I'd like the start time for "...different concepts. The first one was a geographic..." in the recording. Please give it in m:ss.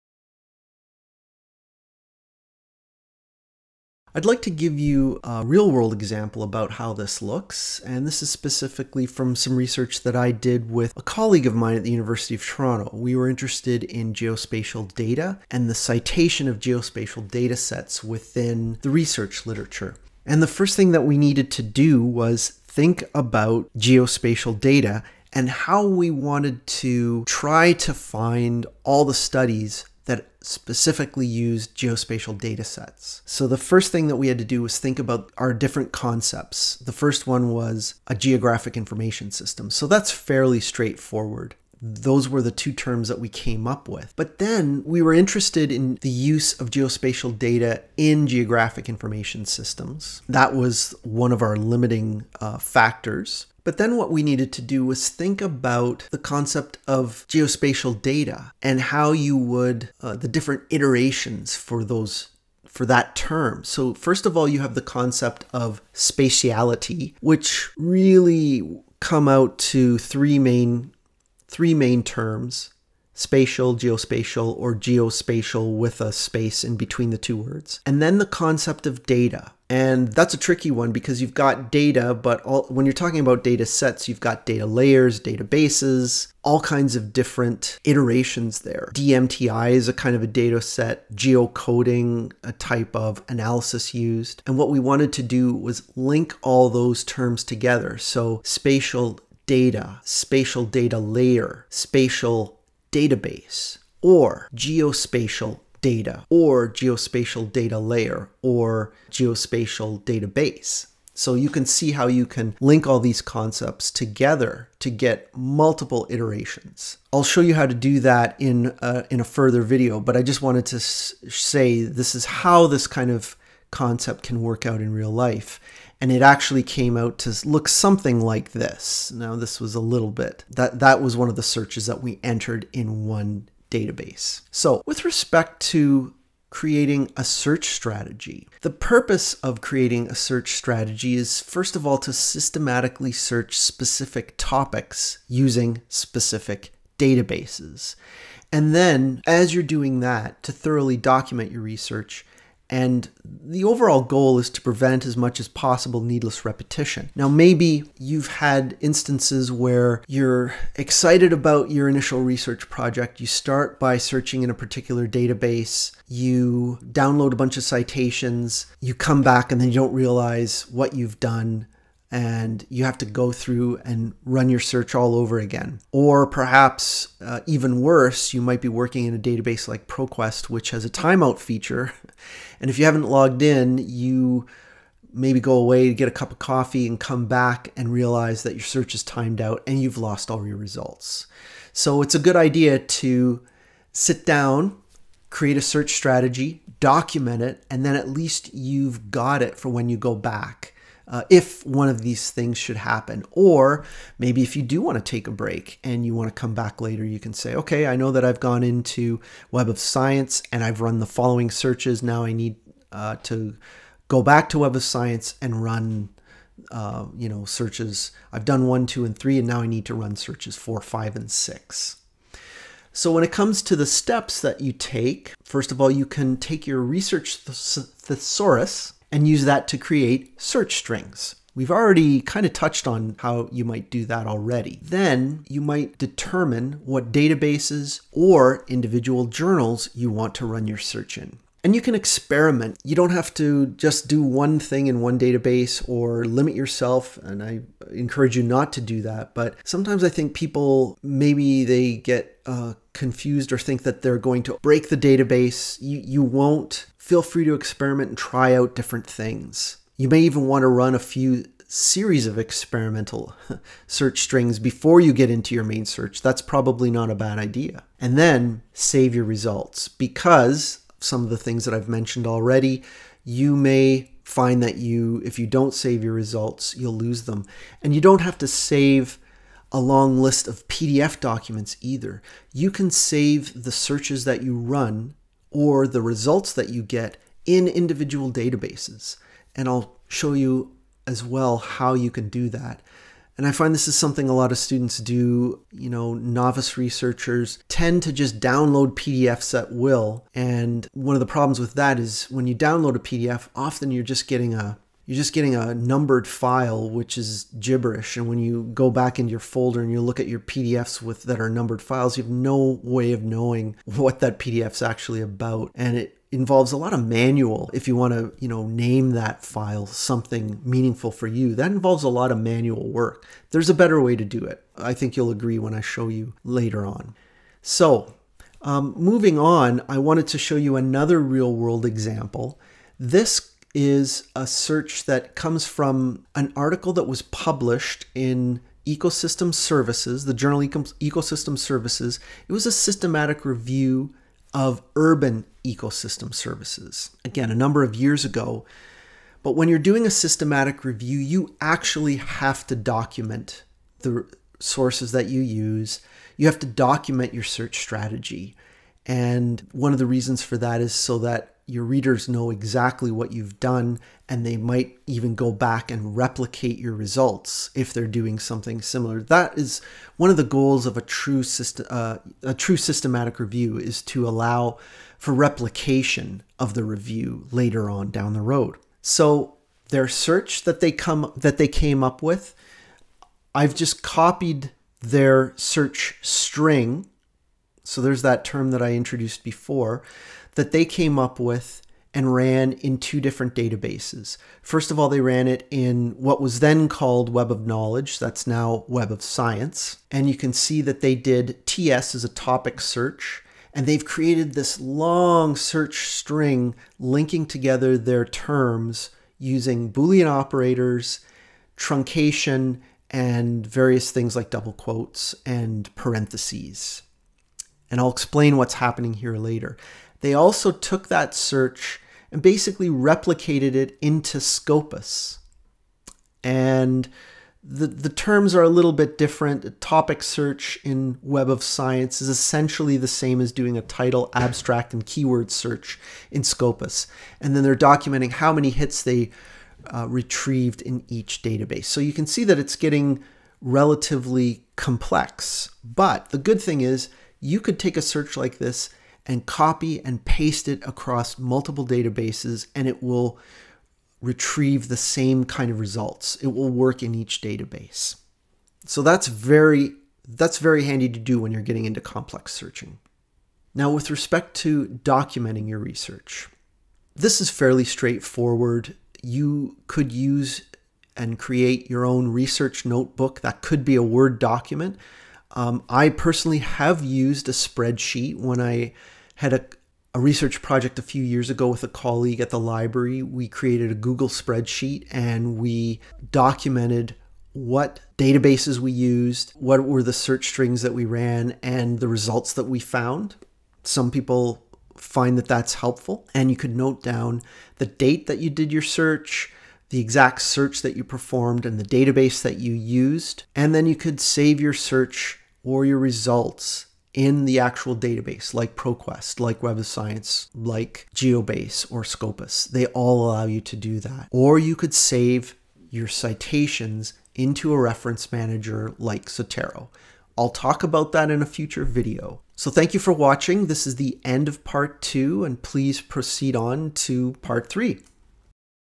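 0:35.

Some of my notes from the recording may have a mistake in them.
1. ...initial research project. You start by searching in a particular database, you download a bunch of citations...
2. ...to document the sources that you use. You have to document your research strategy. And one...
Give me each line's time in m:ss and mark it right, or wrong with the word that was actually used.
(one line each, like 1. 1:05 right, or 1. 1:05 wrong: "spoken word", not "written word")
1. 2:41 right
2. 5:52 wrong: "search", not "research".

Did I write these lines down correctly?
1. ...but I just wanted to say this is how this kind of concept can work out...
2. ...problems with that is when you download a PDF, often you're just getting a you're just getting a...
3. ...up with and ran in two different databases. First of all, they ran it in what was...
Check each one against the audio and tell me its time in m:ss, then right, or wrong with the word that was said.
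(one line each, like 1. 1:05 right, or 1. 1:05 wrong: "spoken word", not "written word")
1. 1:59 right
2. 5:01 right
3. 6:31 right.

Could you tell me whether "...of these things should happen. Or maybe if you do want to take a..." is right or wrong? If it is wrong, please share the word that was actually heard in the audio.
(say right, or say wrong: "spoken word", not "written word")
right.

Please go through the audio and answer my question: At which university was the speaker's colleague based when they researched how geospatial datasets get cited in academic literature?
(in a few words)
University of Toronto.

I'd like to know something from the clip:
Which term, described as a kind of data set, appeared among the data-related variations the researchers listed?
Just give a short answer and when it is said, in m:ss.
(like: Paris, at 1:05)
DMTI, at 1:28.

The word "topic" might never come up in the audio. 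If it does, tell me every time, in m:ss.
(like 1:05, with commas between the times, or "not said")
2:24, 6:42, 7:09.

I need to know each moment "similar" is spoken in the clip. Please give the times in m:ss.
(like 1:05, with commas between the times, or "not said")
6:08.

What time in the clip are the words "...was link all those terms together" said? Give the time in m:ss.
1:35.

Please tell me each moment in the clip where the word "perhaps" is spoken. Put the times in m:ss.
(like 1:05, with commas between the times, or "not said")
2:56.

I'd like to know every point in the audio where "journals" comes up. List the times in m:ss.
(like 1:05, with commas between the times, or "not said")
3:59, 5:40.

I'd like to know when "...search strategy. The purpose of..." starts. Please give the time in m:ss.
2:17.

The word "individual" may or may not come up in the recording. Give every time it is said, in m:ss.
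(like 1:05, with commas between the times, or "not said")
3:58, 4:47.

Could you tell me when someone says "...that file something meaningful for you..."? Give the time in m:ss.
5:19.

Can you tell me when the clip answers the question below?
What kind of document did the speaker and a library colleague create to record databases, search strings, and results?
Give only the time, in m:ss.
8:03.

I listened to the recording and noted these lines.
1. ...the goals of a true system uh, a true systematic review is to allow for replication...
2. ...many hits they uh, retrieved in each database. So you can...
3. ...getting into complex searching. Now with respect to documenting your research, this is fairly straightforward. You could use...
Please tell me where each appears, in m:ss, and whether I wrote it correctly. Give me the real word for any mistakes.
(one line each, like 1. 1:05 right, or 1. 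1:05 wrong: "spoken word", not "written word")
1. 6:10 right
2. 7:18 right
3. 7:41 right.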